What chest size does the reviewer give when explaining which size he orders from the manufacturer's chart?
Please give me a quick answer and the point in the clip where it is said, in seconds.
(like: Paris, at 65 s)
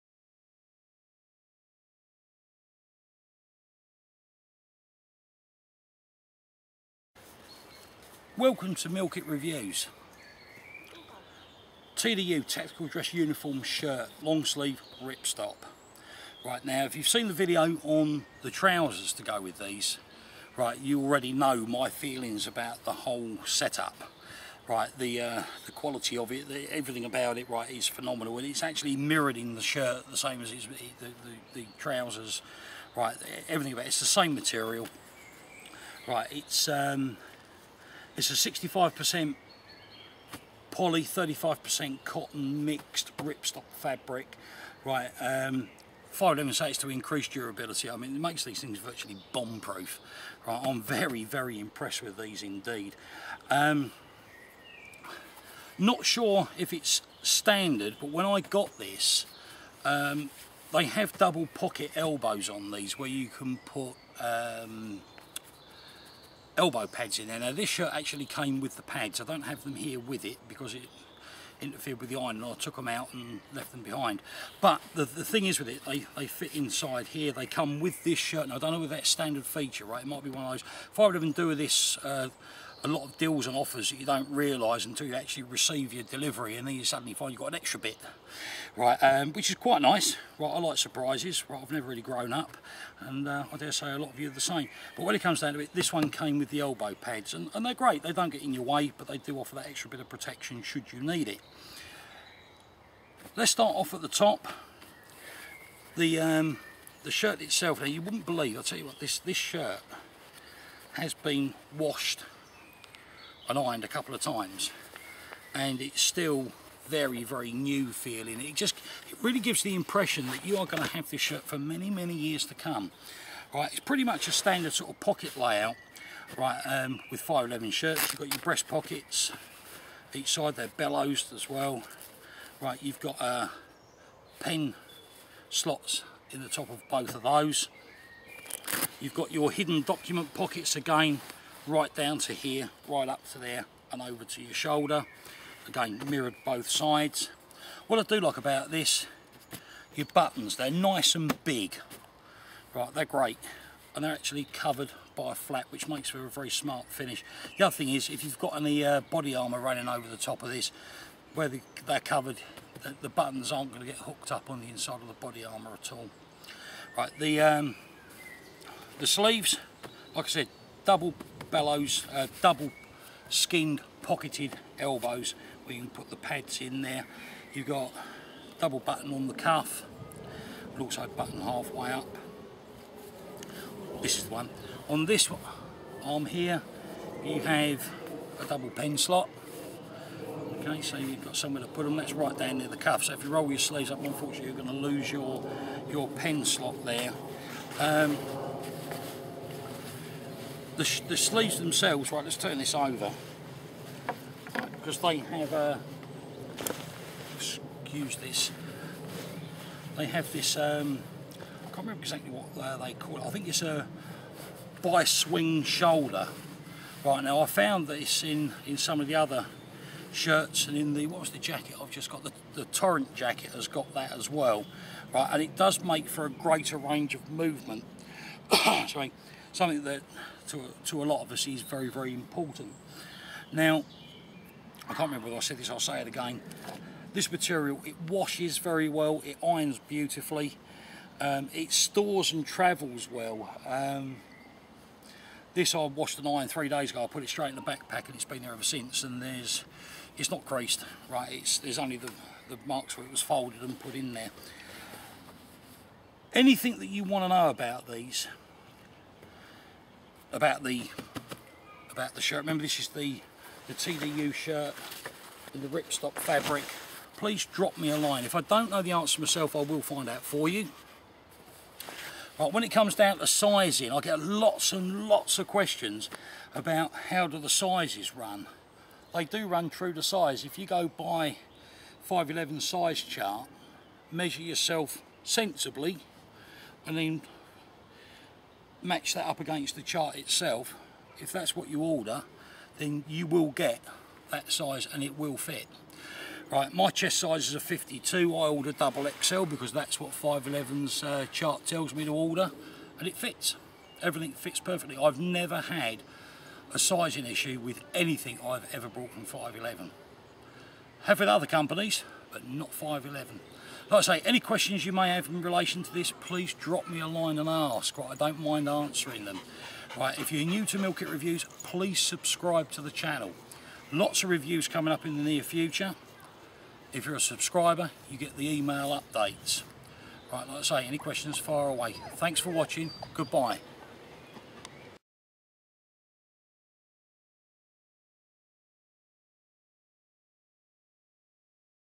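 52, at 297 s.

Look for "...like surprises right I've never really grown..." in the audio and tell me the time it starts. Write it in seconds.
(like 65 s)
90 s.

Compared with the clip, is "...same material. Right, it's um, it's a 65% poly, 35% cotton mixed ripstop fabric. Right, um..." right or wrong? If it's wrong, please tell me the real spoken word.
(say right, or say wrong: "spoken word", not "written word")
right.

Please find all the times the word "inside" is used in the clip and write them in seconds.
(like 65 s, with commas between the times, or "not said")
76 s, 164 s.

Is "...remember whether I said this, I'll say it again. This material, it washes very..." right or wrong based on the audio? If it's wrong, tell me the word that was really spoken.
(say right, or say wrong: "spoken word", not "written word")
right.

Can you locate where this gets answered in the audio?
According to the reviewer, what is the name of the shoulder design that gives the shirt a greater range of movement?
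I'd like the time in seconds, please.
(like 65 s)
214 s.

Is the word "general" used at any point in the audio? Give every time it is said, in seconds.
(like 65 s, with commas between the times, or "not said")
not said.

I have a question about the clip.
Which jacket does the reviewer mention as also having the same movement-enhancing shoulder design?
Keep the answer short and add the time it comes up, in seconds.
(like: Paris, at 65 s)
Torrent jacket, at 222 s.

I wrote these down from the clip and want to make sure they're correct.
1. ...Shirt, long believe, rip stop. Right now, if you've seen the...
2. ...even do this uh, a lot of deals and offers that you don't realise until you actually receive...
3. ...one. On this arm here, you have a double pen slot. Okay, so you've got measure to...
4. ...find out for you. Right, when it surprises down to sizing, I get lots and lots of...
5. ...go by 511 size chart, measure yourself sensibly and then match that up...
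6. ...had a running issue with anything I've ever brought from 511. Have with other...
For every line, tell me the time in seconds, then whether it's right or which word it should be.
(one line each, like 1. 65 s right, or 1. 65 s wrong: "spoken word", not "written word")
1. 13 s wrong: "sleeve", not "believe"
2. 81 s right
3. 184 s wrong: "somewhere", not "measure"
4. 269 s wrong: "comes", not "surprises"
5. 280 s right
6. 305 s wrong: "sizing", not "running".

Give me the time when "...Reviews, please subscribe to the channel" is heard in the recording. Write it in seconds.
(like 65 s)
321 s.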